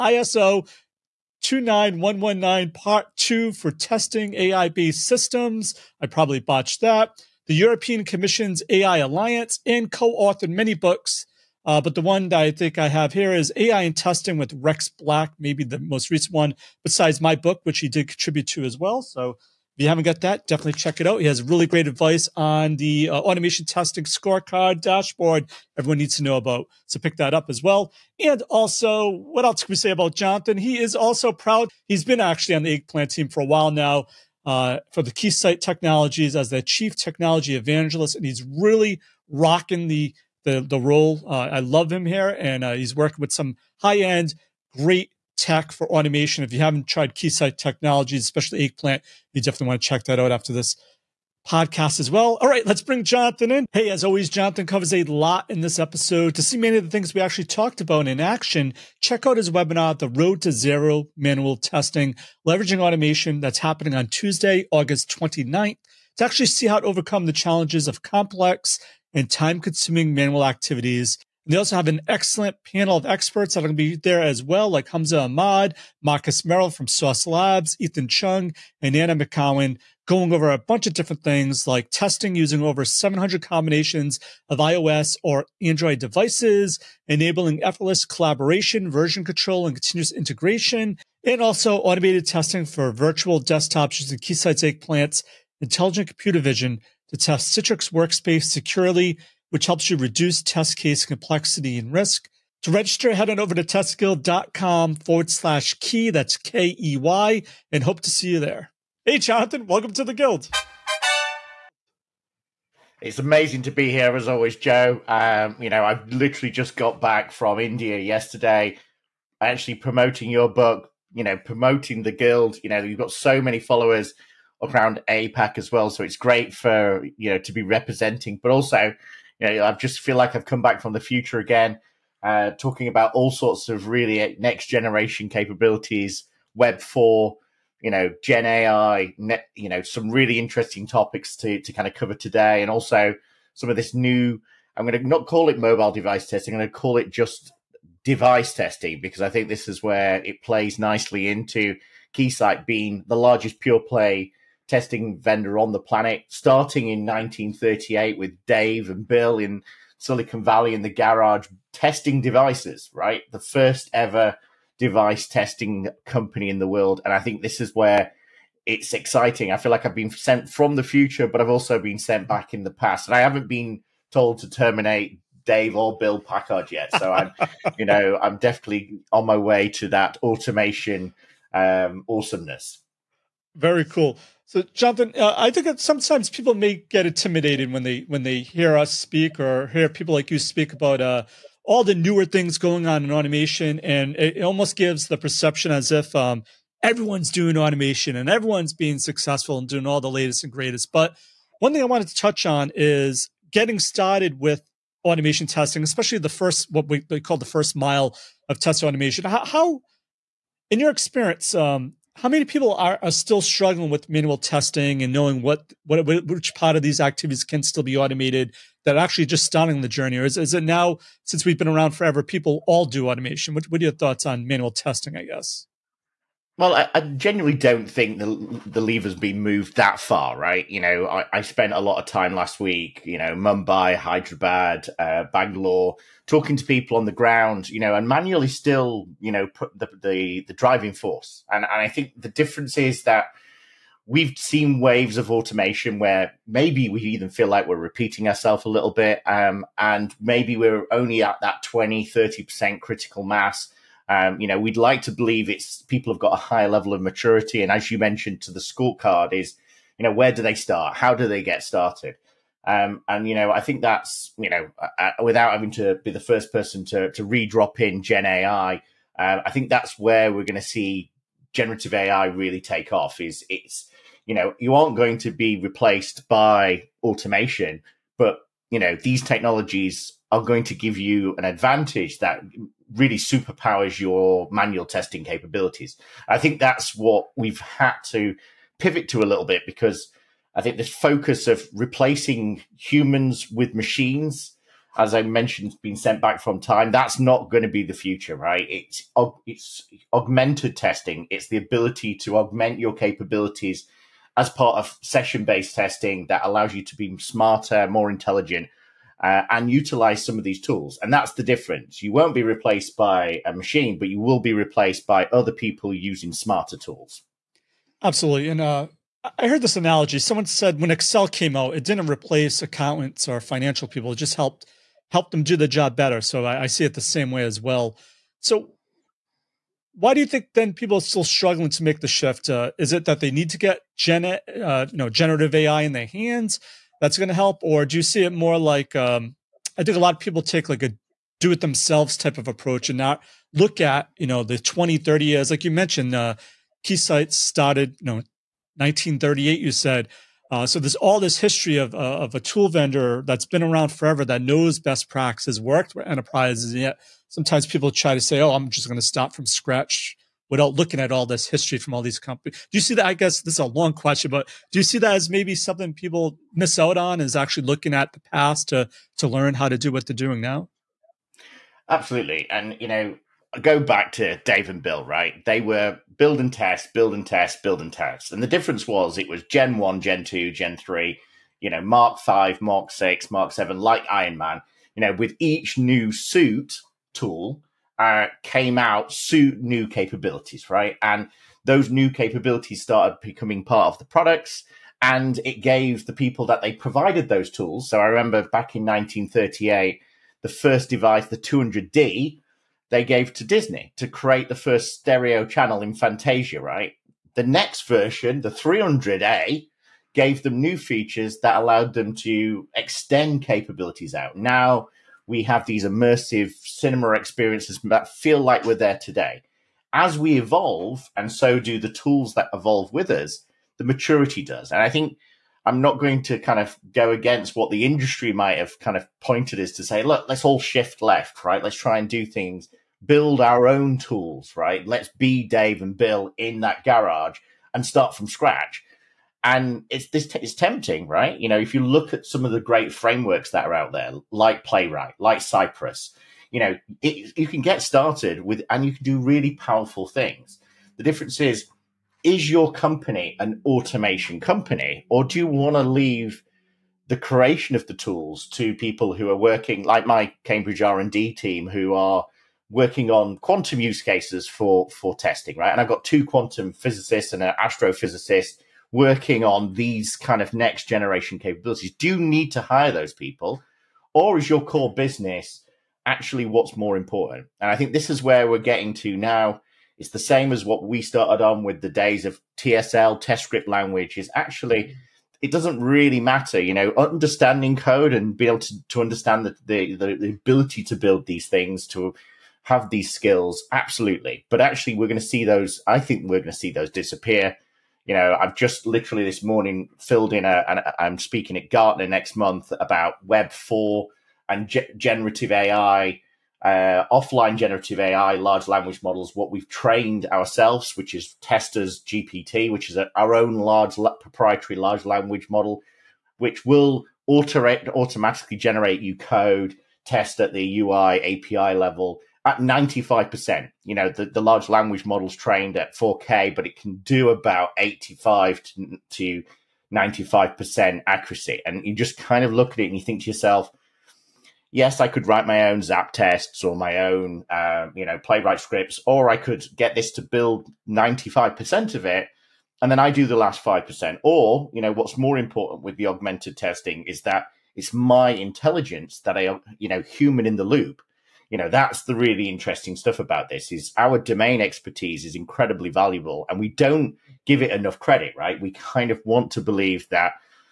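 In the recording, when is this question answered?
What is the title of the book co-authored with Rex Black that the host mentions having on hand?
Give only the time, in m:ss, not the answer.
0:13.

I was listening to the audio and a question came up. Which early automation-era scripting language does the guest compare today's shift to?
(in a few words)
test script language.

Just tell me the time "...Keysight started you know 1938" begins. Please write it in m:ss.
5:46.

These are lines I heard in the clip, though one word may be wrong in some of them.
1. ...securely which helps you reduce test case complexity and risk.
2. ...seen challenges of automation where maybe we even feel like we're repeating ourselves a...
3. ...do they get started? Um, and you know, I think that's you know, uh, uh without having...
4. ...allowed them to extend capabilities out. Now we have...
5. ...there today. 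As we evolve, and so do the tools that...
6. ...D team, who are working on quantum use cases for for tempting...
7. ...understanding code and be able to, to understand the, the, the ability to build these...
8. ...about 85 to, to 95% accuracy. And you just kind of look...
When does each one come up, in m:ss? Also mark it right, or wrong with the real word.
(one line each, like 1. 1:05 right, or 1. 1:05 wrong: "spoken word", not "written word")
1. 1:38 right
2. 4:04 wrong: "waves", not "challenges"
3. 4:21 right
4. 6:51 right
5. 6:58 right
6. 7:41 wrong: "testing", not "tempting"
7. 8:06 right
8. 8:47 right.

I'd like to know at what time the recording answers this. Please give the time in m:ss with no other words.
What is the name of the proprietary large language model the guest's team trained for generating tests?
8:31.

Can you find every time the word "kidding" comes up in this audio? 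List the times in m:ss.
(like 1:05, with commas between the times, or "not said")
not said.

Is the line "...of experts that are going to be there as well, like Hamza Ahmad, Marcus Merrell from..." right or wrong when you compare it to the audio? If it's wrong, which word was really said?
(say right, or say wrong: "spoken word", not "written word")
right.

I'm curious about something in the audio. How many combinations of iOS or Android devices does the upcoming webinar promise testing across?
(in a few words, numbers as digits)
over 700.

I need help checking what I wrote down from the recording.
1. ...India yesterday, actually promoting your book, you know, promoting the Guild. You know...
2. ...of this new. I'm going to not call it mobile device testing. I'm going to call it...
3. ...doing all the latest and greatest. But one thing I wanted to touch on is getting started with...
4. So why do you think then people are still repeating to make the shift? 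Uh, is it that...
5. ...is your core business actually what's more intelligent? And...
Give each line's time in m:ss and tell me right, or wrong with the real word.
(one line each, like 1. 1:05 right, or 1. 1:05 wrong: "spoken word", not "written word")
1. 1:57 right
2. 2:23 right
3. 3:19 right
4. 5:28 wrong: "struggling", not "repeating"
5. 7:54 wrong: "important", not "intelligent".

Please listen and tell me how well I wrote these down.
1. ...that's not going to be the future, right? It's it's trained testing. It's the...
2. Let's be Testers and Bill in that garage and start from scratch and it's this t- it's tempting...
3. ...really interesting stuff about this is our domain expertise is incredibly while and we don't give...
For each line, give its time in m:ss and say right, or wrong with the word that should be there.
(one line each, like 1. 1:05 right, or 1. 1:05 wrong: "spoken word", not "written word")
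1. 4:56 wrong: "augmented", not "trained"
2. 7:14 wrong: "Dave", not "Testers"
3. 9:12 wrong: "valuable", not "while".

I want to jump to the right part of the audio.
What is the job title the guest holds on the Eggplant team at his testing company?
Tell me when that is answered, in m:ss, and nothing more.
0:36.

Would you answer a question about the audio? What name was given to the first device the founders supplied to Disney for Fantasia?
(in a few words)
200D.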